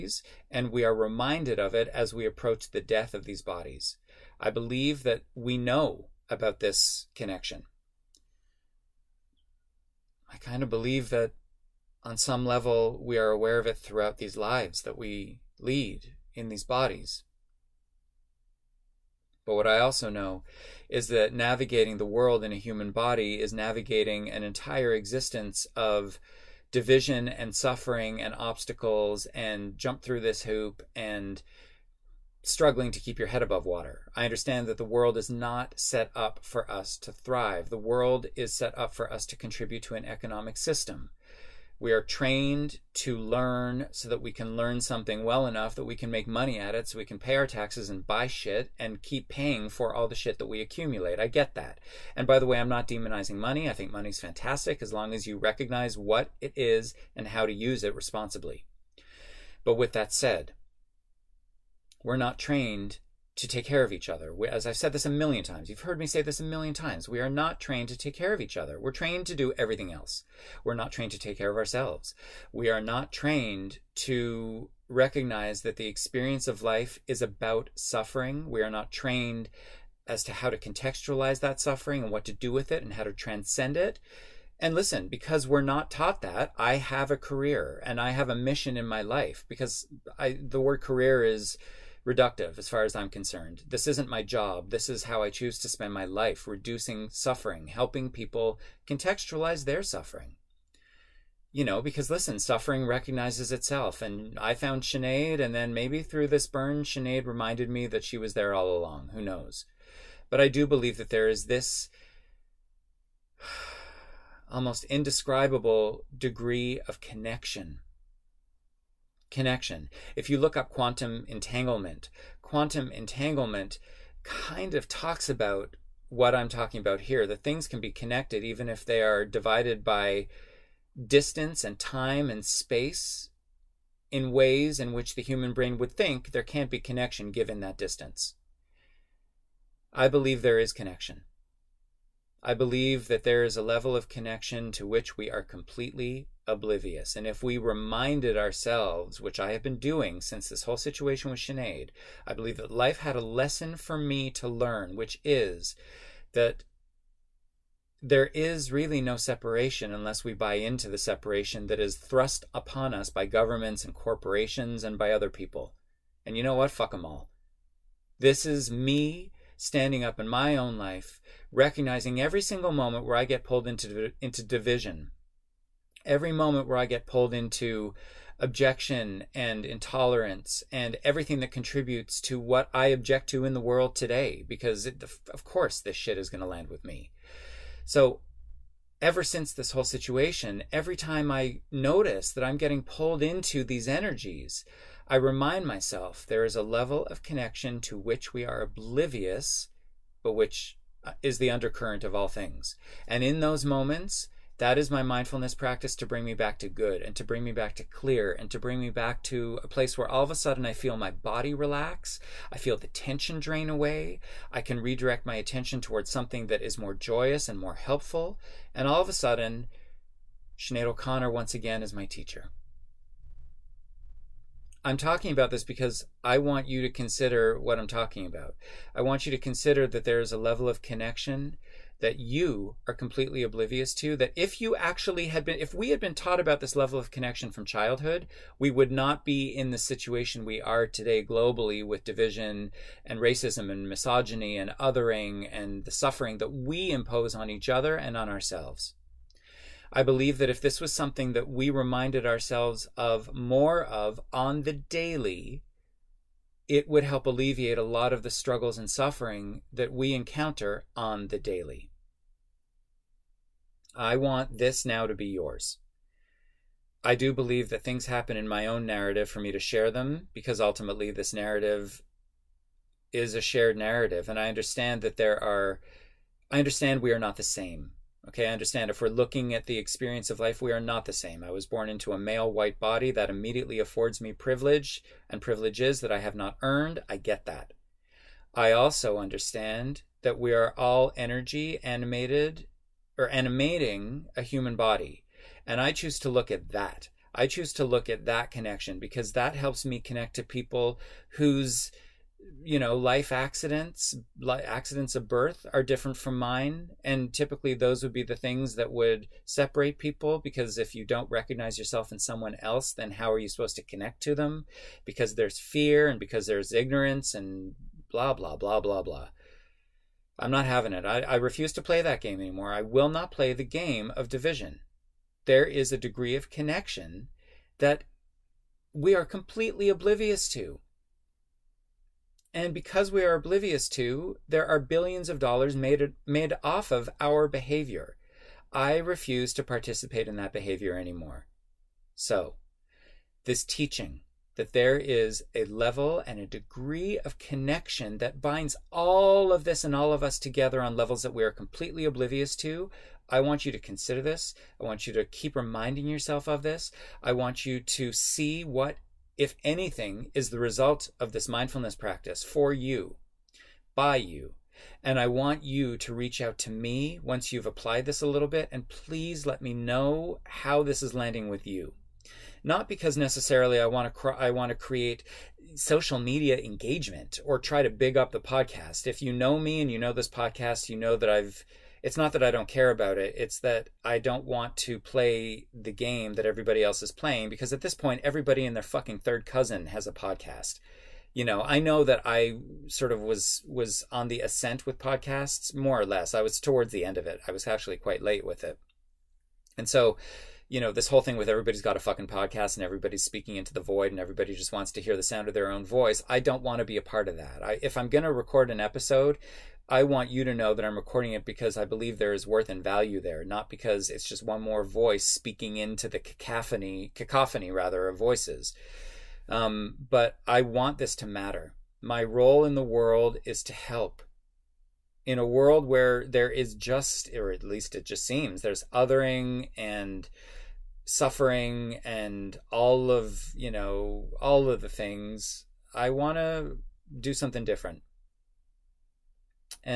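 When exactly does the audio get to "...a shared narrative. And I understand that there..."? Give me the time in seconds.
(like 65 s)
273 s.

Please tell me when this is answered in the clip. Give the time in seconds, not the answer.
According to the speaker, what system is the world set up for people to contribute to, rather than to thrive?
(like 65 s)
40 s.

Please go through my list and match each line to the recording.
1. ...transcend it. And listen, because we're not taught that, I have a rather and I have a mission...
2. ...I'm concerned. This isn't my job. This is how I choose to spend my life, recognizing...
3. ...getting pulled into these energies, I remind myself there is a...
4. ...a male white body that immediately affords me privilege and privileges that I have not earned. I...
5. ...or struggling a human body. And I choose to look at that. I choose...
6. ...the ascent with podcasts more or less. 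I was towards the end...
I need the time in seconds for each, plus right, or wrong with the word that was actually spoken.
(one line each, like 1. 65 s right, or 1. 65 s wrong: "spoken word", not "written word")
1. 83 s wrong: "career", not "rather"
2. 92 s wrong: "reducing", not "recognizing"
3. 192 s right
4. 282 s right
5. 293 s wrong: "animating", not "struggling"
6. 394 s right.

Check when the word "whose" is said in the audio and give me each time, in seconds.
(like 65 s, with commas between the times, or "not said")
301 s.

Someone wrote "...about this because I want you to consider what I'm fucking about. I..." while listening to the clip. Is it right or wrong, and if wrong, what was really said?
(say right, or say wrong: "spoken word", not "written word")
wrong: "talking", not "fucking".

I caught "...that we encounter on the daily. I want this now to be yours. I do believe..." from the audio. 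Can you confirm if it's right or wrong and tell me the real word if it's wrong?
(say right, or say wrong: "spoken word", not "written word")
right.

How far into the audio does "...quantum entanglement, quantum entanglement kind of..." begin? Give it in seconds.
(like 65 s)
120 s.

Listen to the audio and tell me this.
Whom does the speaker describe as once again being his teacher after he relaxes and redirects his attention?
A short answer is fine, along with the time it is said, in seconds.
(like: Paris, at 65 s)
Sinead O'Connor, at 220 s.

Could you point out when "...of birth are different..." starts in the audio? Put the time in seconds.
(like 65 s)
305 s.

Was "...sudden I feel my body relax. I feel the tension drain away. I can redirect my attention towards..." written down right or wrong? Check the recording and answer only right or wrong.
right.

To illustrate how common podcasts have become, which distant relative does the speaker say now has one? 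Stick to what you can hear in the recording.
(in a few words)
Third cousin.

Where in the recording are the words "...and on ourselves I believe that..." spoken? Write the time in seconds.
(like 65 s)
247 s.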